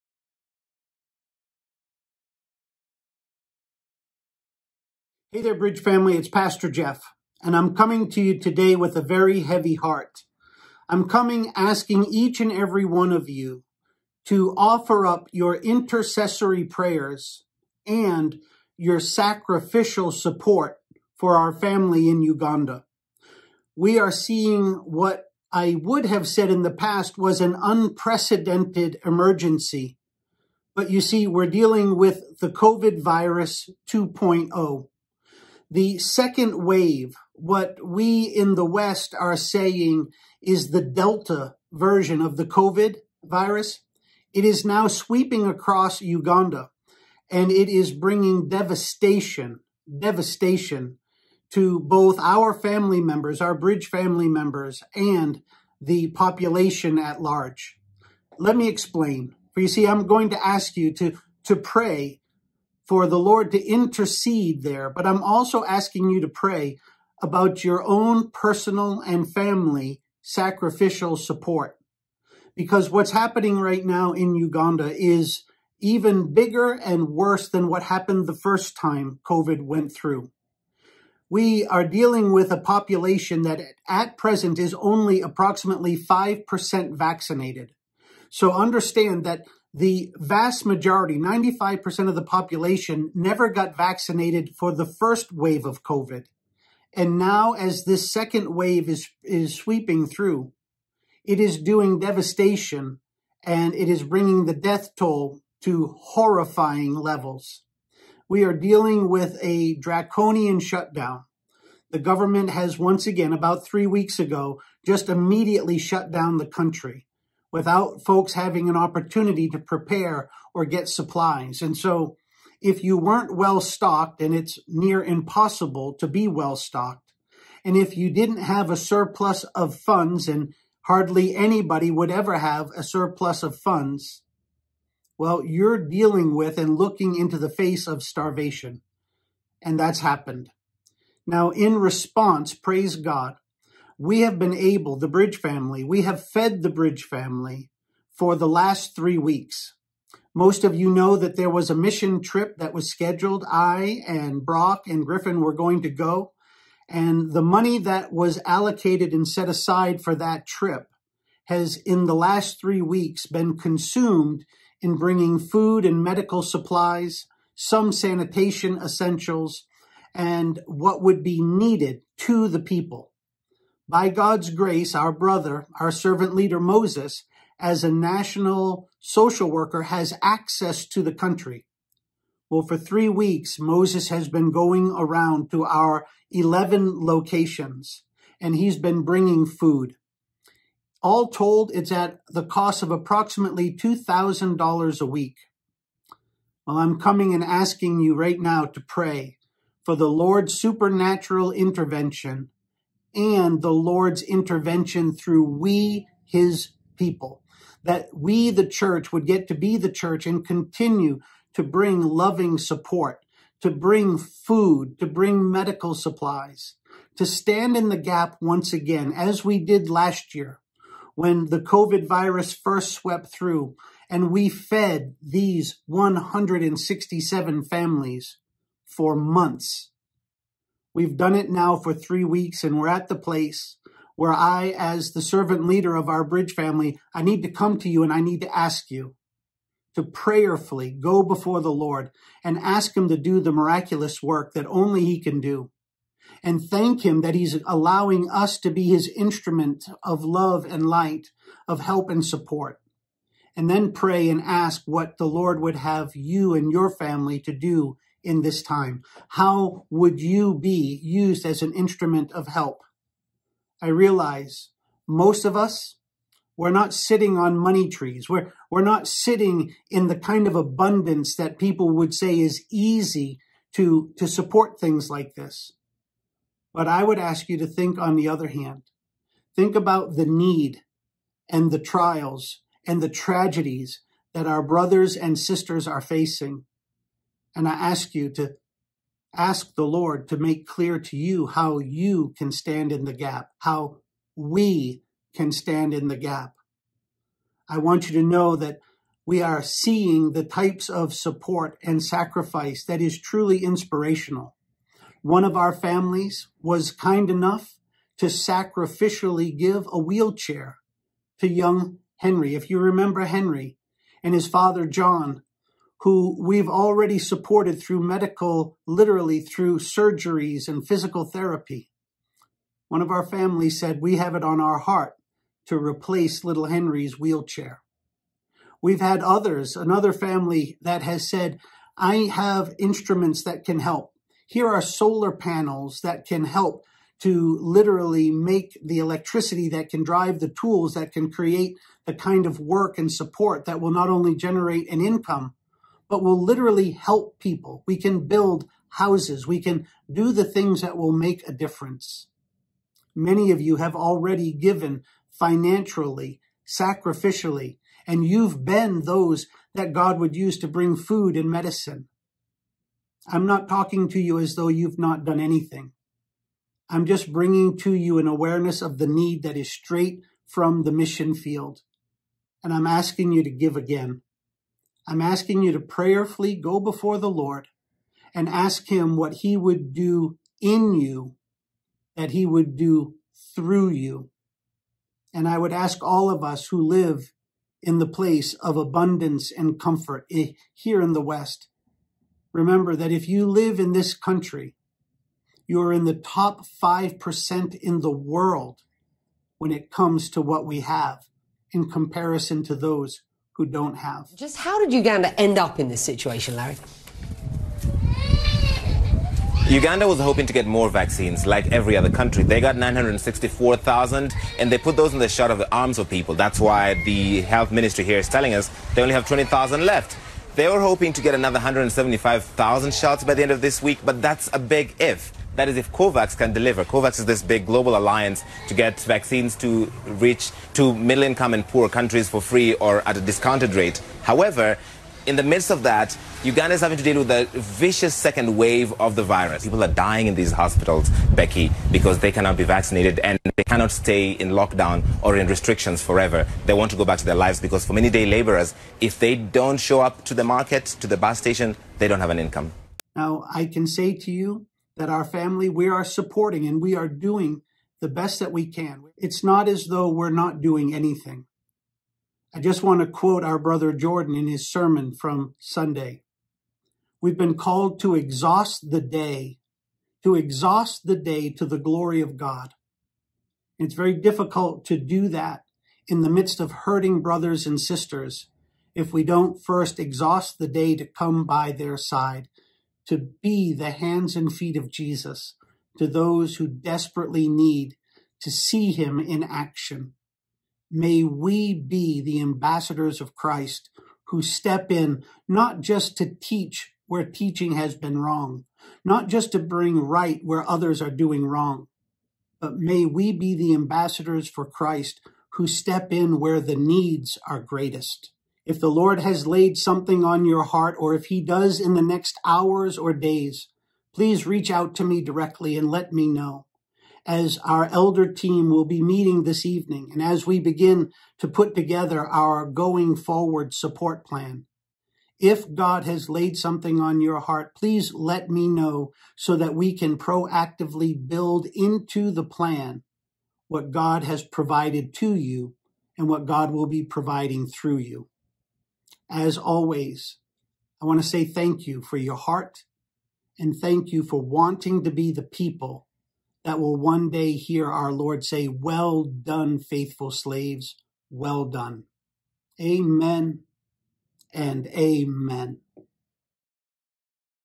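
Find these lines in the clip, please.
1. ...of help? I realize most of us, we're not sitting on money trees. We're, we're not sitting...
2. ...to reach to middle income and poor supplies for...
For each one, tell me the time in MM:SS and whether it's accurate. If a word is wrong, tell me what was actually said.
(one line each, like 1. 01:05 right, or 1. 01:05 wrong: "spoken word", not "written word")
1. 04:22 right
2. 07:09 wrong: "countries", not "supplies".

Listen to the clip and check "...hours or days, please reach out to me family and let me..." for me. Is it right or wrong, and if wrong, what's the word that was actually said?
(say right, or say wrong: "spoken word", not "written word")
wrong: "directly", not "family".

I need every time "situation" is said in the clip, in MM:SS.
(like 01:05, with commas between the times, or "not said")
06:46.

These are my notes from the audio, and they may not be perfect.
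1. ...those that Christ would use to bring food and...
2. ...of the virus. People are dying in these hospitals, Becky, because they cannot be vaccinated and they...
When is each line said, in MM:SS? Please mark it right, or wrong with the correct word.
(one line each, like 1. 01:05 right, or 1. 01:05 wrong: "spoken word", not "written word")
1. 05:59 wrong: "God", not "Christ"
2. 07:18 right.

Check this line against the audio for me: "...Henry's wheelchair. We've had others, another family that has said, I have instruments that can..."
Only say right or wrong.
right.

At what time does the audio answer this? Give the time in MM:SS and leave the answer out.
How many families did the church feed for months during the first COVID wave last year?
03:45.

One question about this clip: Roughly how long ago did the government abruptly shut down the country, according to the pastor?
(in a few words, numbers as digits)
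About three weeks ago.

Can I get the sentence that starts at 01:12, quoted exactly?
Because what's happening right now in Uganda is even bigger and worse than what happened the first time COVID went through.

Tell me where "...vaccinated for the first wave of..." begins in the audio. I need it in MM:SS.
01:33.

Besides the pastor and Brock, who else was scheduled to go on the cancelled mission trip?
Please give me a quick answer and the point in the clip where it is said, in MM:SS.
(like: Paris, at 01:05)
Griffin, at 02:35.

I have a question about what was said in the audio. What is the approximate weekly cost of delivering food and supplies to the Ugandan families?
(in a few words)
$2,000.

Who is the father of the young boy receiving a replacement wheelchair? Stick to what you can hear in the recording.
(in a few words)
John.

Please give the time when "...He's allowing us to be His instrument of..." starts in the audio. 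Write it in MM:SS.
04:07.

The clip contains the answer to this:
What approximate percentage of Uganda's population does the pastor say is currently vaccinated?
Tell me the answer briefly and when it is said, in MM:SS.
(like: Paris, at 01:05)
5%, at 01:25.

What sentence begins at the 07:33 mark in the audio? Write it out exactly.
Now, I can say to you, that our family we are supporting and we are doing the best that we can.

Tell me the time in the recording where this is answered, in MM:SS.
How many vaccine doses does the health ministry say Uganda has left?
06:59.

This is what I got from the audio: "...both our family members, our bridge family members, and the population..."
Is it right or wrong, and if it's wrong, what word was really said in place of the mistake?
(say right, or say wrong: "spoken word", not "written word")
right.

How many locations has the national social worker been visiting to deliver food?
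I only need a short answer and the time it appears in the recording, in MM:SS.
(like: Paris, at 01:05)
11, at 03:06.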